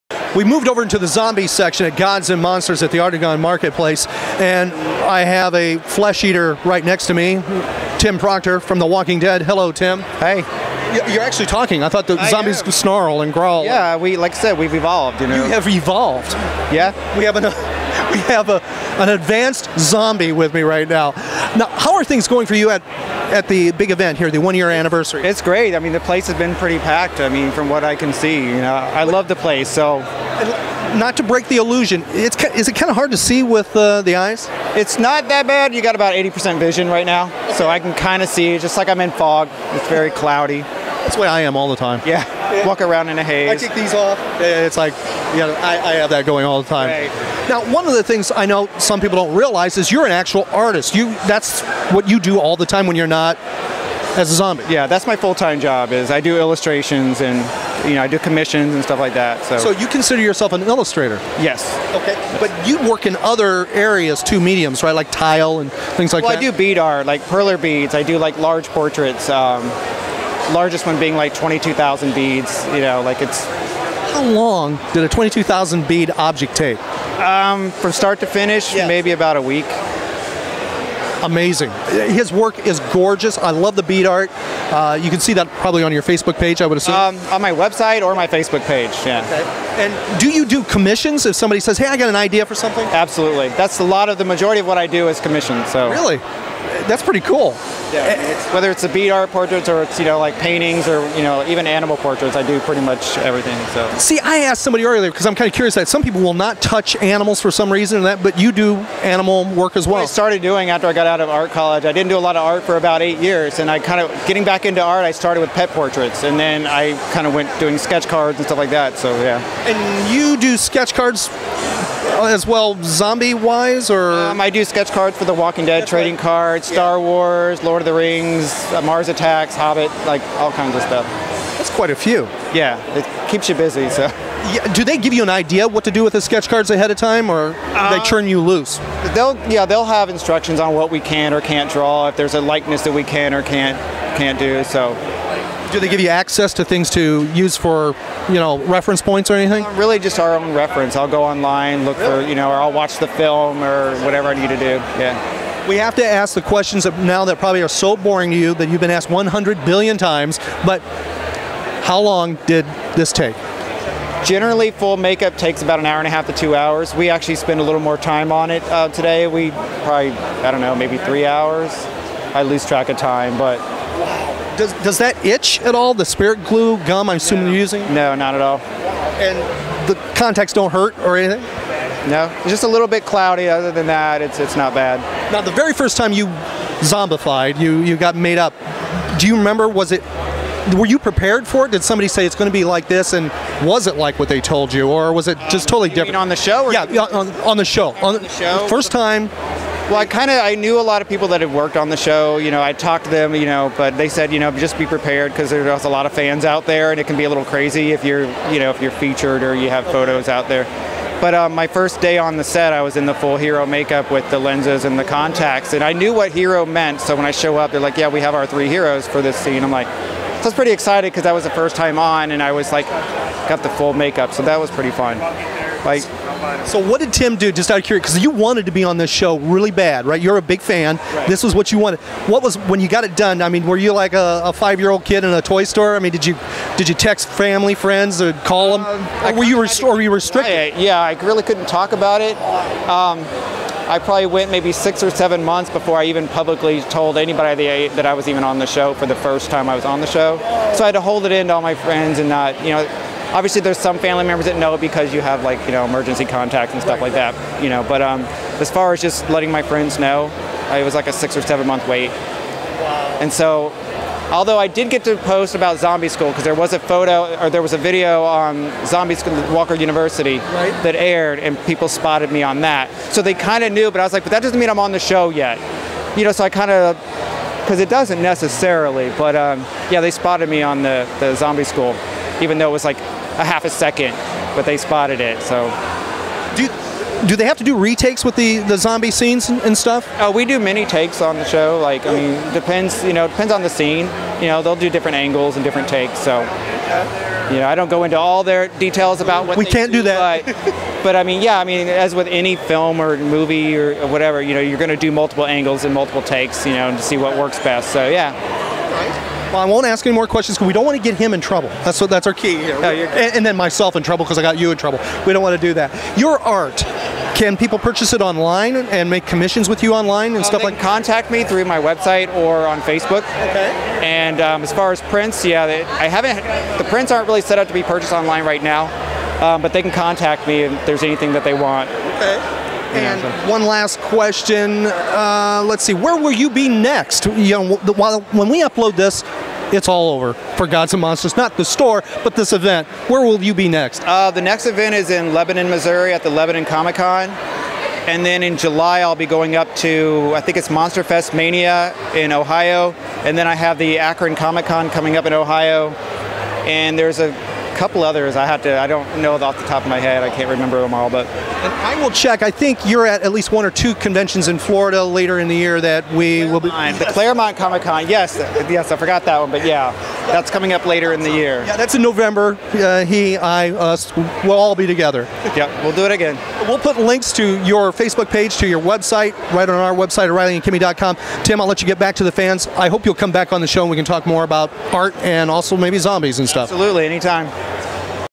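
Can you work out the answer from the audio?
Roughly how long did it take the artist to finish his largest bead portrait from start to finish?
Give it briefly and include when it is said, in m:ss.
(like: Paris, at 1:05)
about a week, at 1:18.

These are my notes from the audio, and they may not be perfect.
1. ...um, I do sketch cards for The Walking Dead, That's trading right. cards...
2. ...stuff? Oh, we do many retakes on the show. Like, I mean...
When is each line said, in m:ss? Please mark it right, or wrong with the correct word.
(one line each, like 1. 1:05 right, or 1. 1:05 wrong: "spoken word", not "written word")
1. 2:04 right
2. 4:49 wrong: "takes", not "retakes".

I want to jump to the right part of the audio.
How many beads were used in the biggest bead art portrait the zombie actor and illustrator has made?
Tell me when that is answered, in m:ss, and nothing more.
1:11.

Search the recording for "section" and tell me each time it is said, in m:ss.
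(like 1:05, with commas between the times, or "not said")
0:01.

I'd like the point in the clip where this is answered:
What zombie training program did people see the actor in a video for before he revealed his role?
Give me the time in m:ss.
4:29.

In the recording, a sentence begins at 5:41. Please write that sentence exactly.
Not the store, but this event.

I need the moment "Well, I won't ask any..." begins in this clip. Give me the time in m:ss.
5:09.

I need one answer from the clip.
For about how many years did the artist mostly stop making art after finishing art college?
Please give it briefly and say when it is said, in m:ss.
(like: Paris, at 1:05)
eight years, at 1:53.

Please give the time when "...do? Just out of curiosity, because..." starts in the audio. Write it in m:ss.
3:47.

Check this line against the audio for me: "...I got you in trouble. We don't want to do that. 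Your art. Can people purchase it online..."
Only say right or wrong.
right.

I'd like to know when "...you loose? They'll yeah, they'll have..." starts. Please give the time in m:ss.
2:18.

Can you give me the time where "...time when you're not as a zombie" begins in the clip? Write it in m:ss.
0:52.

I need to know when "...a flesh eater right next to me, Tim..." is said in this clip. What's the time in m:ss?
0:05.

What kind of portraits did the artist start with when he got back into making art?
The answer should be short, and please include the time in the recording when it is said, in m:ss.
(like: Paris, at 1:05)
pet portraits, at 1:55.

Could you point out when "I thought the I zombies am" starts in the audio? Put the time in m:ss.
0:11.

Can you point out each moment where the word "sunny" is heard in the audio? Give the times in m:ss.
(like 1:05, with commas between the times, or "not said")
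not said.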